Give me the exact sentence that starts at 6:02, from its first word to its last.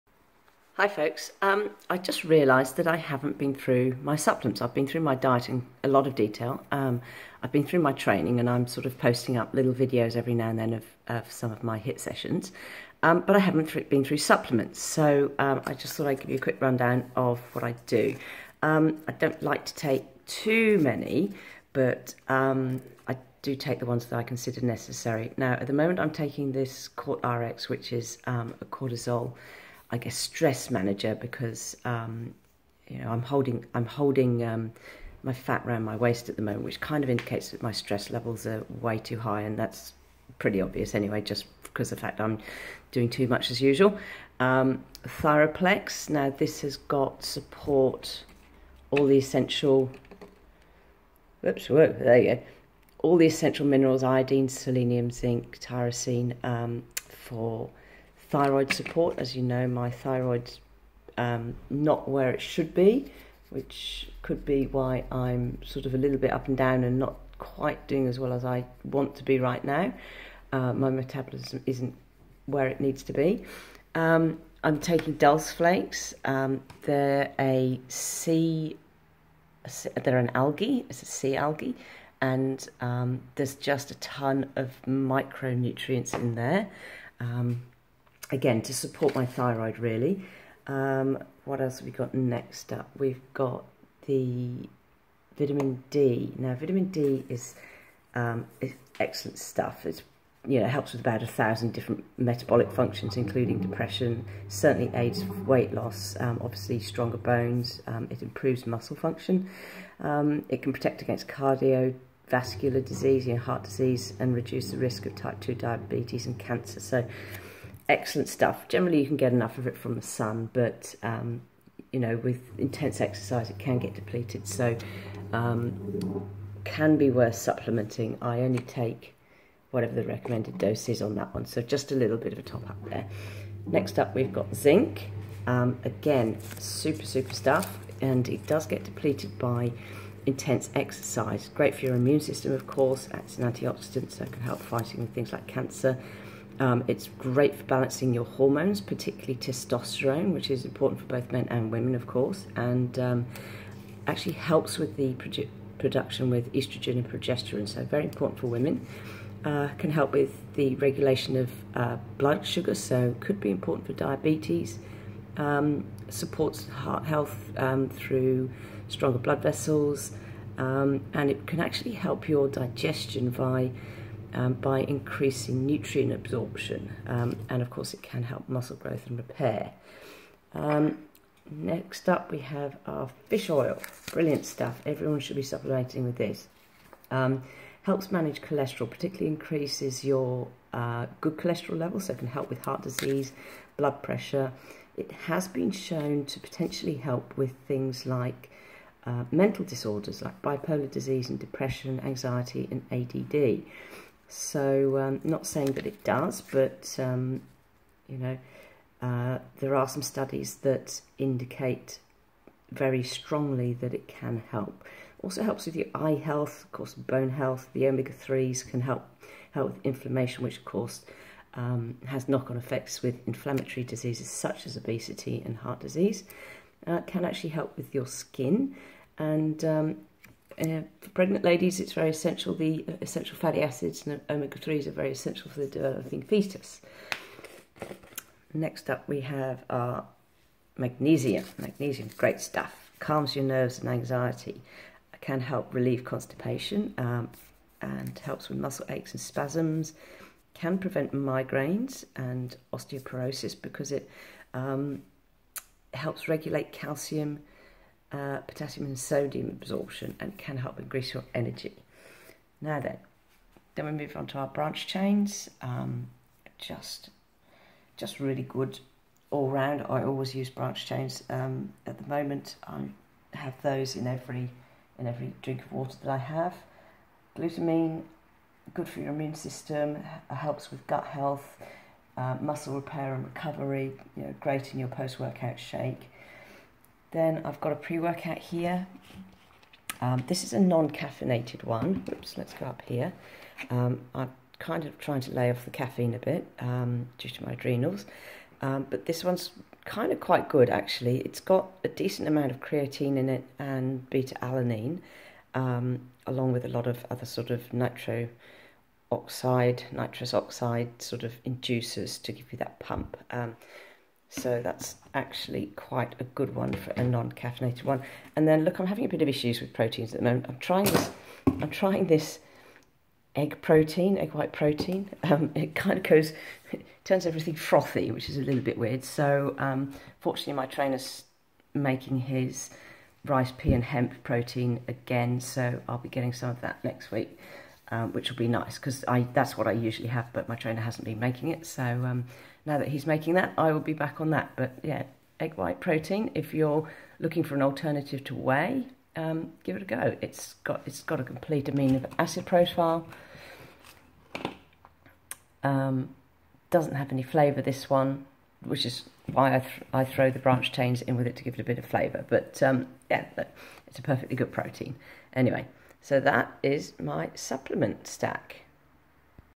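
But um, yeah, look, it's a perfectly good protein.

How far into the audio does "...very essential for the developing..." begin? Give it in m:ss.
3:54.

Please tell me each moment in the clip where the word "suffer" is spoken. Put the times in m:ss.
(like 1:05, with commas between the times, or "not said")
not said.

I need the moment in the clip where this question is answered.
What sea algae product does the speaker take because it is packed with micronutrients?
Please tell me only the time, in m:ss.
1:15.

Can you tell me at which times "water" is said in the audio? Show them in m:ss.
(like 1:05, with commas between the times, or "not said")
4:35.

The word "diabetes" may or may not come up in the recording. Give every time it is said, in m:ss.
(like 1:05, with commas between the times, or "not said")
1:55, 2:43.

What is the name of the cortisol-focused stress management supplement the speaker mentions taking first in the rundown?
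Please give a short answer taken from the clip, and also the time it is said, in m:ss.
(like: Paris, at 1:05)
Cort RX, at 0:26.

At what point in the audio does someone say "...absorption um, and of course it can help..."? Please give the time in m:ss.
2:56.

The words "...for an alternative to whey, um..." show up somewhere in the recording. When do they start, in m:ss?
5:47.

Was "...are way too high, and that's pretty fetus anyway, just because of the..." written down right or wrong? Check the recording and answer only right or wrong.
wrong.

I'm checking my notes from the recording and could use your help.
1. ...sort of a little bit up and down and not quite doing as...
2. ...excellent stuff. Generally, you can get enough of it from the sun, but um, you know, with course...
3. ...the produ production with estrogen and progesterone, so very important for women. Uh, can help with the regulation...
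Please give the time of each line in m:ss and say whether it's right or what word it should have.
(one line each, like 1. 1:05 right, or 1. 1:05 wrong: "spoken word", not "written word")
1. 1:05 right
2. 1:57 wrong: "intense", not "course"
3. 2:34 right.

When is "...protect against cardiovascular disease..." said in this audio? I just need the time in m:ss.
1:50.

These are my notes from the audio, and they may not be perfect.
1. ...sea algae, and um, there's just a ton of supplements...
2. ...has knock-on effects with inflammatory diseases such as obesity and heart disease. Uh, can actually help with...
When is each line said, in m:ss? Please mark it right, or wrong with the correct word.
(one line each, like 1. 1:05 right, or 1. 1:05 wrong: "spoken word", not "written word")
1. 1:21 wrong: "micronutrients", not "supplements"
2. 3:42 right.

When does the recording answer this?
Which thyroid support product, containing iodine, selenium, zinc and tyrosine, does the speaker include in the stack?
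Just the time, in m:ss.
0:45.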